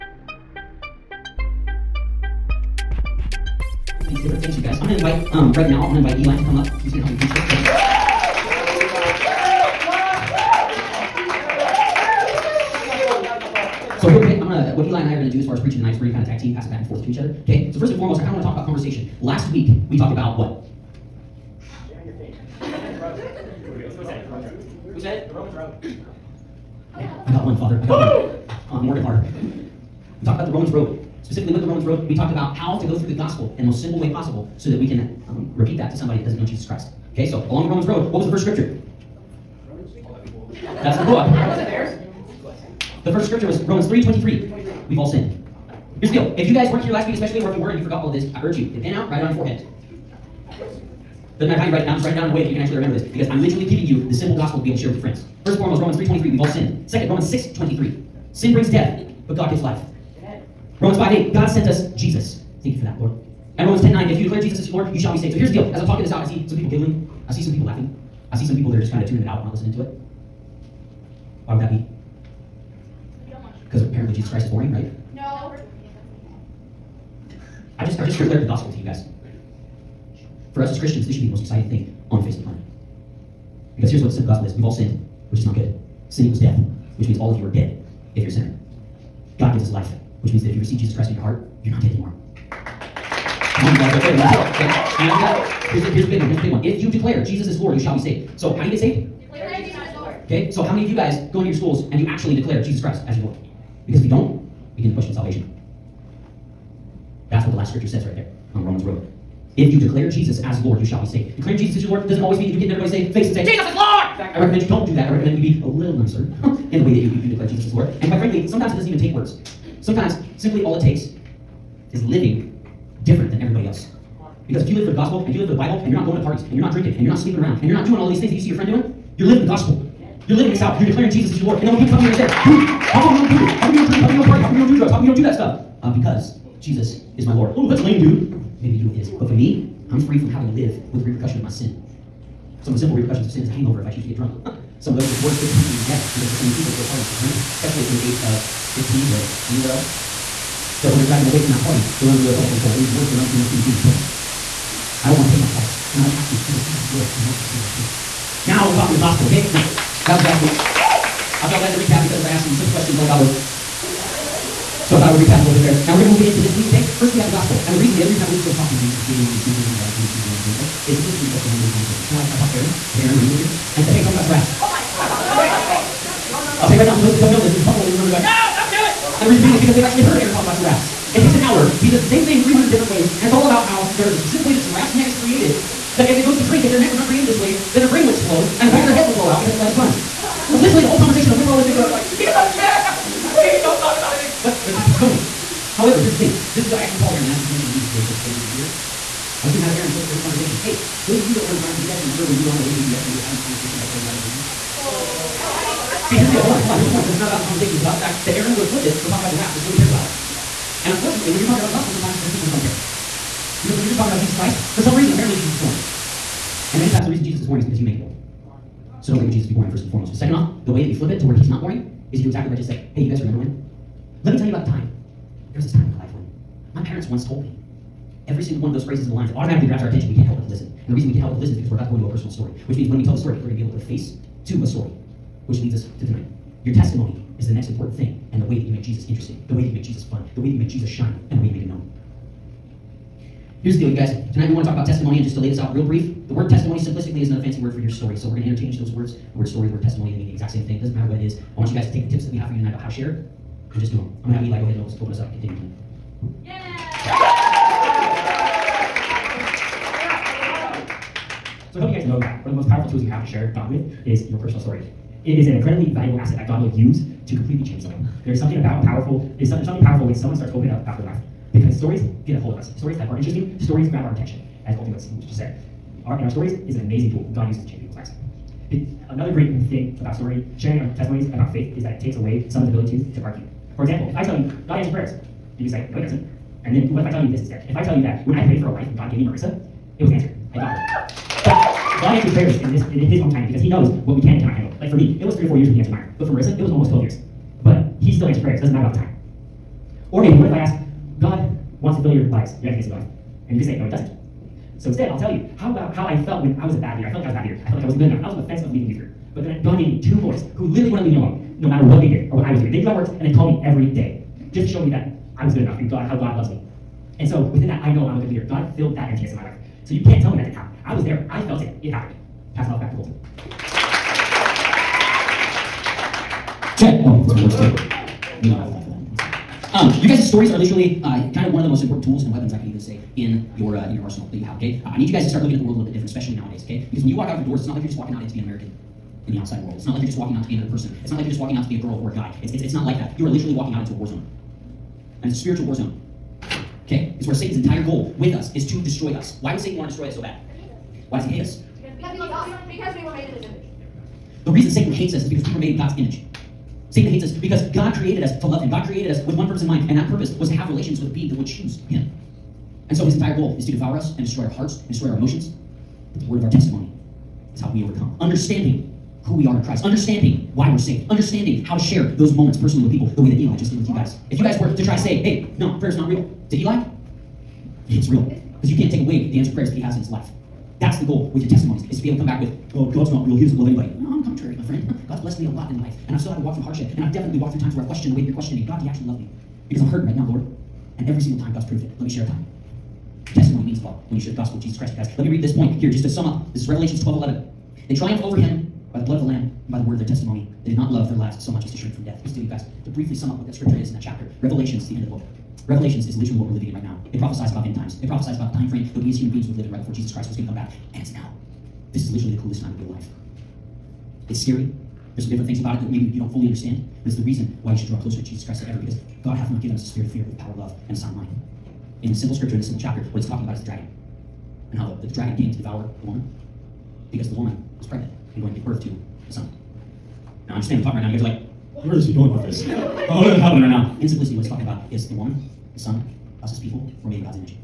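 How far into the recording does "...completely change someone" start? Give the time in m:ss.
4:27.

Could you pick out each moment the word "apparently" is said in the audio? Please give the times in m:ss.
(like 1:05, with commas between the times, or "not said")
1:13, 3:35.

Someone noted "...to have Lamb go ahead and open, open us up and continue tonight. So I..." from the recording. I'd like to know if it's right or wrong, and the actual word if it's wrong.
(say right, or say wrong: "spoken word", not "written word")
wrong: "Eli", not "Lamb".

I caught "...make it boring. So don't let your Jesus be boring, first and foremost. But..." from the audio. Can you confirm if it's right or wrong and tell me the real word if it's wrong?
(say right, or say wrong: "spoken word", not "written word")
right.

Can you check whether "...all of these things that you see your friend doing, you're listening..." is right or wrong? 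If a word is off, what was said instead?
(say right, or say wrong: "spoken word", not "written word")
wrong: "living", not "listening".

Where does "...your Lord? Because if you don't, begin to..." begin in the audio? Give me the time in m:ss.
1:43.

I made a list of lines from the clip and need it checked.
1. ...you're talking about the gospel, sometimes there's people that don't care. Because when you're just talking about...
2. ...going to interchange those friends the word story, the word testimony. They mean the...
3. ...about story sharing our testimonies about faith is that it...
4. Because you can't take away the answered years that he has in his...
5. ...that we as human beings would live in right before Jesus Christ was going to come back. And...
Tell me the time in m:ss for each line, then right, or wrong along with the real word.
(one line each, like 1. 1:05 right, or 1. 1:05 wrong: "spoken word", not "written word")
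1. 3:31 right
2. 4:08 wrong: "words", not "friends"
3. 4:39 right
4. 6:18 wrong: "prayers", not "years"
5. 6:48 right.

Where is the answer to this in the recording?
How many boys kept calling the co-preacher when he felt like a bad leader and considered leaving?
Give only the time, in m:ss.
5:10.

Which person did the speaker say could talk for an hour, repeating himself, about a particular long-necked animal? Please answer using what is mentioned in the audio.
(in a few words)
Aaron Rennie.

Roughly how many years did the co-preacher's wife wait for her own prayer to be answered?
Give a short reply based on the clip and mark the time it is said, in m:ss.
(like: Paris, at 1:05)
12, at 4:56.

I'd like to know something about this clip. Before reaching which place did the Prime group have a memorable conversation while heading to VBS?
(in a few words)
Paisley.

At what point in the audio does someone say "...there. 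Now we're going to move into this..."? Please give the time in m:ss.
2:45.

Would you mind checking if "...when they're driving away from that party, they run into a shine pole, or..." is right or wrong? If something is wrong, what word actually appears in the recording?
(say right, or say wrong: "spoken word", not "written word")
wrong: "telephone", not "shine".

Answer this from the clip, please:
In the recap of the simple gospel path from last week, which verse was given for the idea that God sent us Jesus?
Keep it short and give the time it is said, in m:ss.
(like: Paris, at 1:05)
Romans 5:8, at 1:00.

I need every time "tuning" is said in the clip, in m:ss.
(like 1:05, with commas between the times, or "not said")
1:09.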